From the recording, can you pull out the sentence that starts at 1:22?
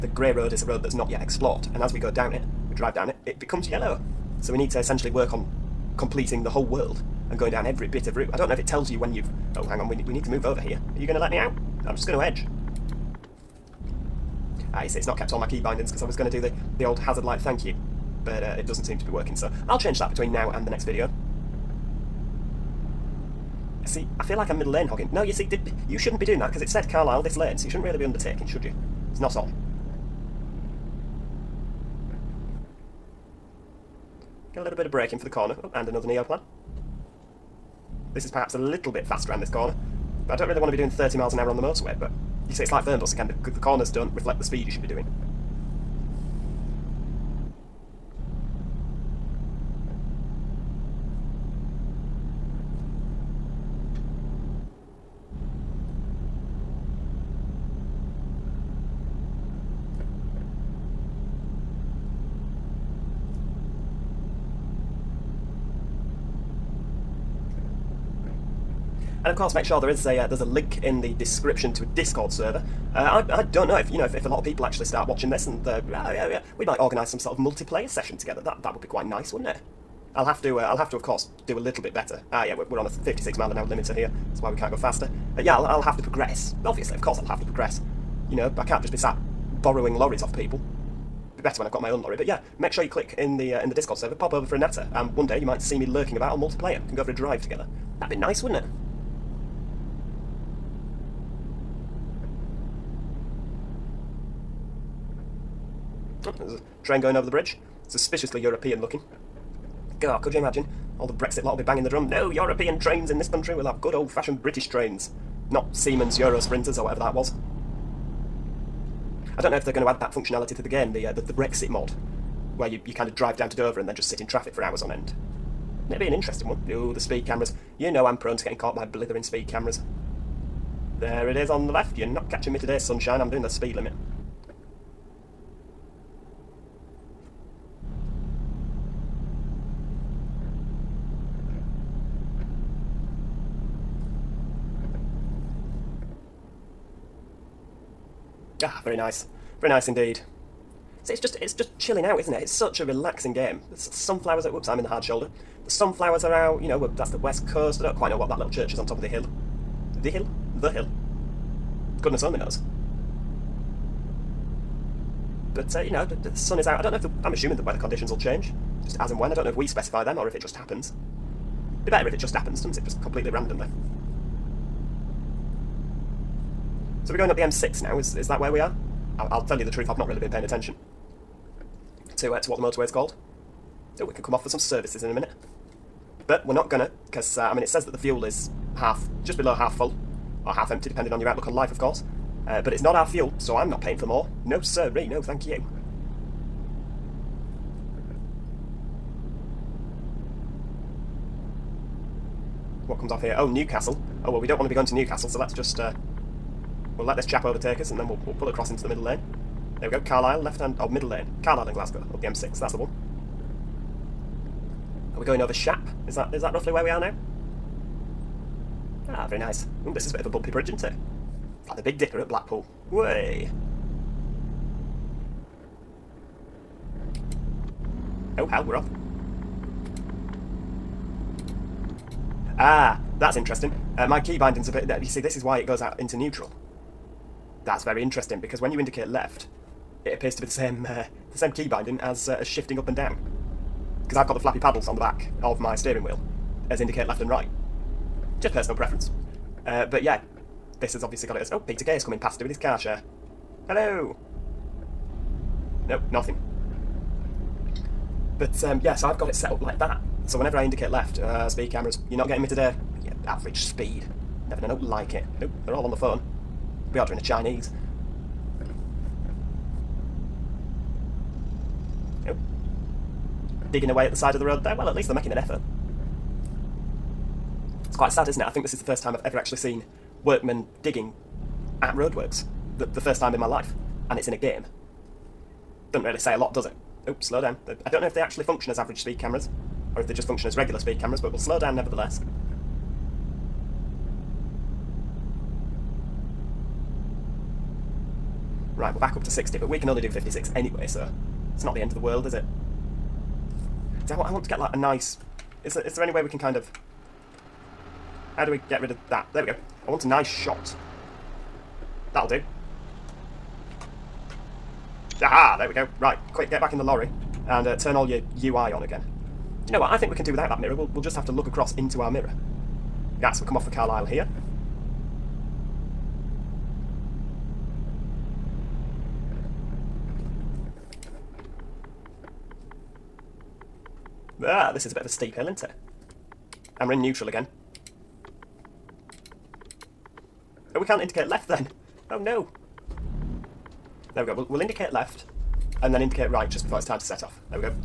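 Ah yeah, we're, we're on a 56 mile an hour limiter here.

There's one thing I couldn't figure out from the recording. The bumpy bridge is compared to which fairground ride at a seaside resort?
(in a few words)
Big Dipper.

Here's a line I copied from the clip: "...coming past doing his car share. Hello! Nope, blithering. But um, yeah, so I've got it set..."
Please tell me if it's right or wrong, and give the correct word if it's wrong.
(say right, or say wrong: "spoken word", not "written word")
wrong: "nothing", not "blithering".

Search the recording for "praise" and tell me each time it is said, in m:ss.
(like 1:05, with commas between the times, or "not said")
not said.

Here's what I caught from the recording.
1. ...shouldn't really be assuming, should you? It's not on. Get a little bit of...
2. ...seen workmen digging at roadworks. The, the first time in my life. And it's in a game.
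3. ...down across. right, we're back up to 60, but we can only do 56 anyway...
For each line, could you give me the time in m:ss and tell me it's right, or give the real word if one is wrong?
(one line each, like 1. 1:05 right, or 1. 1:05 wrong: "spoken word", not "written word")
1. 0:27 wrong: "undertaking", not "assuming"
2. 4:39 right
3. 4:51 wrong: "nevertheless", not "across".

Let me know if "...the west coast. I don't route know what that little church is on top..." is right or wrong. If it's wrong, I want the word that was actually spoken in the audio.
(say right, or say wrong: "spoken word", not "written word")
wrong: "quite", not "route".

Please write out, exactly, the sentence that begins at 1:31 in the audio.
Be better when I've got my own lorry.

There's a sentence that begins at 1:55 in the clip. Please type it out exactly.
Not Siemens Euro Sprinters or whatever that was.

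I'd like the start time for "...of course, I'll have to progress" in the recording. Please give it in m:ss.
1:26.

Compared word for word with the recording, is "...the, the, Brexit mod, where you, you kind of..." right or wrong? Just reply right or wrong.
right.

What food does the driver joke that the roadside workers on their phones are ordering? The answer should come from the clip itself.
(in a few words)
A Chinese.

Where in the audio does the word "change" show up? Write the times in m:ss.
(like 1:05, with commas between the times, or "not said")
0:19, 2:48.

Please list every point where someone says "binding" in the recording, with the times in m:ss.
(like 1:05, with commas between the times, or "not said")
0:15, 3:54, 4:01.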